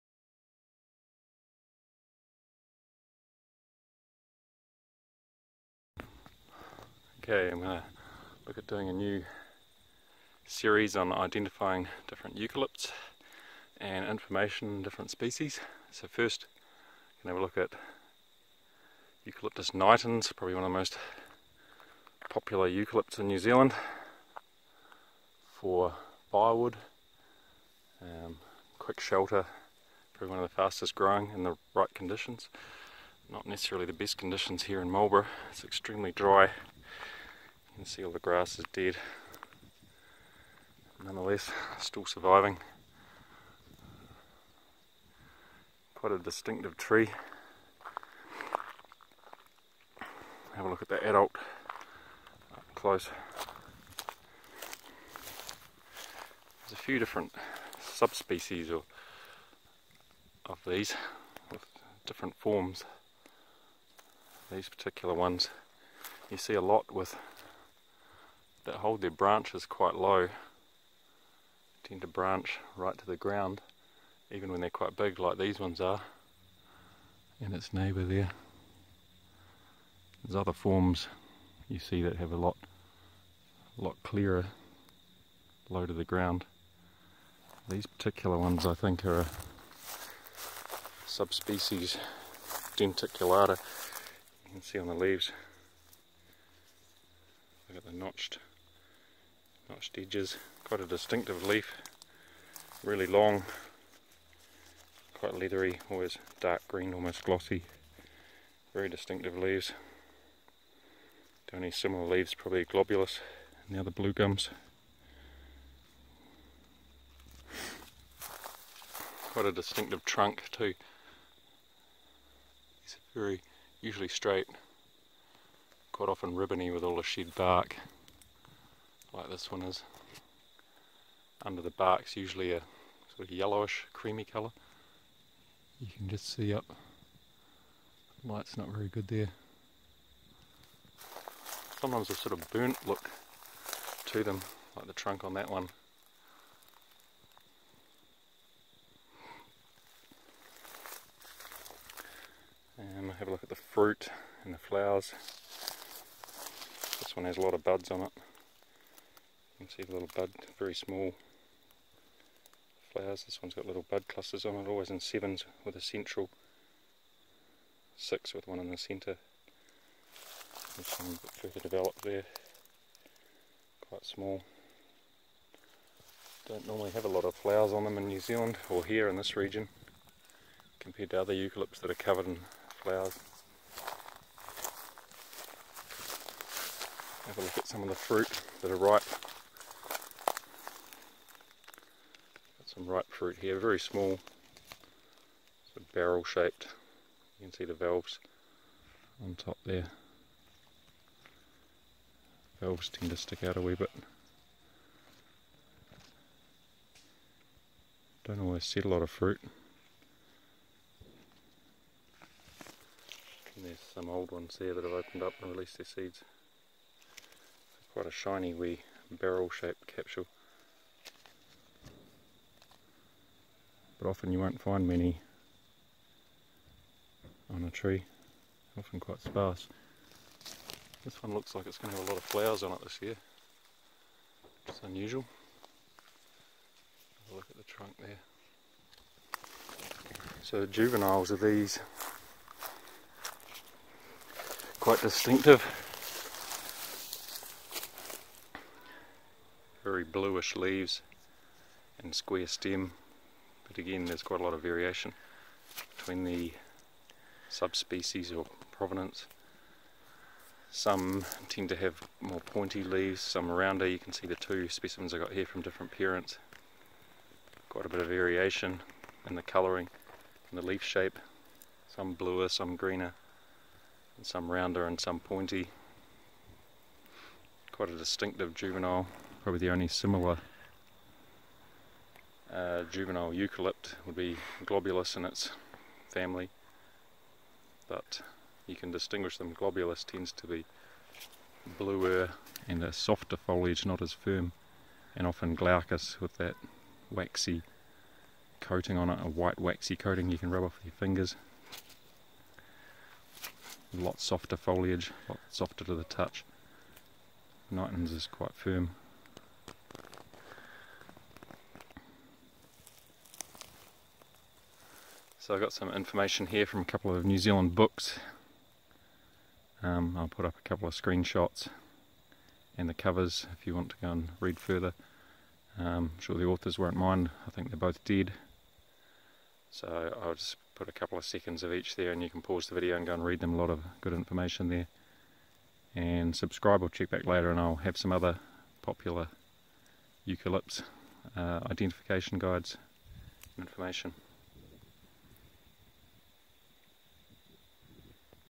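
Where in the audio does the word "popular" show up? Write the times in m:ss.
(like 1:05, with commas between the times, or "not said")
0:22, 5:38.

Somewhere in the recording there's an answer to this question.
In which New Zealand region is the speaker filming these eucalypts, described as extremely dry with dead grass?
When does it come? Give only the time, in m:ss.
0:34.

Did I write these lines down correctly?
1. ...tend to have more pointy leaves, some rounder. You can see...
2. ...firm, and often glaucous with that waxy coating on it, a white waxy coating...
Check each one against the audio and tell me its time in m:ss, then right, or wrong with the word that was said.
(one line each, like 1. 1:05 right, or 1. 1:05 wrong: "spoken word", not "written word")
1. 4:21 right
2. 4:54 right.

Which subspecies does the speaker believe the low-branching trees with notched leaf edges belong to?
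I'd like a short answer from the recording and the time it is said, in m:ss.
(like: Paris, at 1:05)
denticulata, at 1:32.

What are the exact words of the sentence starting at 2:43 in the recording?
This one's got little bud clusters on it, always in sevens with a central, six with one in the centre.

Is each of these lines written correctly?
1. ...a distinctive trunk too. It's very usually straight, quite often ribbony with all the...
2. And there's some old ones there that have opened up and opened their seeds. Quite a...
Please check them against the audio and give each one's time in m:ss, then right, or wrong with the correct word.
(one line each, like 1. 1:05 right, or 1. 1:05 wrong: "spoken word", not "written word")
1. 1:59 right
2. 3:33 wrong: "released", not "opened".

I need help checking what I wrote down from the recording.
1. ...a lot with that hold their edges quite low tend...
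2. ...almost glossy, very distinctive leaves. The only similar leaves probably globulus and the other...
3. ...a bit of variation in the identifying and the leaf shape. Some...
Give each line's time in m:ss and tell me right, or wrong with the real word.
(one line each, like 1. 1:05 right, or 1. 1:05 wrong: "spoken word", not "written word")
1. 1:06 wrong: "branches", not "edges"
2. 1:46 right
3. 4:27 wrong: "colouring", not "identifying".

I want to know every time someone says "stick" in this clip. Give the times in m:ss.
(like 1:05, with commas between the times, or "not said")
3:23.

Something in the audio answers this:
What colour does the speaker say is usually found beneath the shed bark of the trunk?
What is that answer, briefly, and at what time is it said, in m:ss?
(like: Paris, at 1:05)
yellowish, creamy, at 2:13.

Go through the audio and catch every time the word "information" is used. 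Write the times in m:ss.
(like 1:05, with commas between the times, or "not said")
0:14, 5:15, 5:34, 5:43.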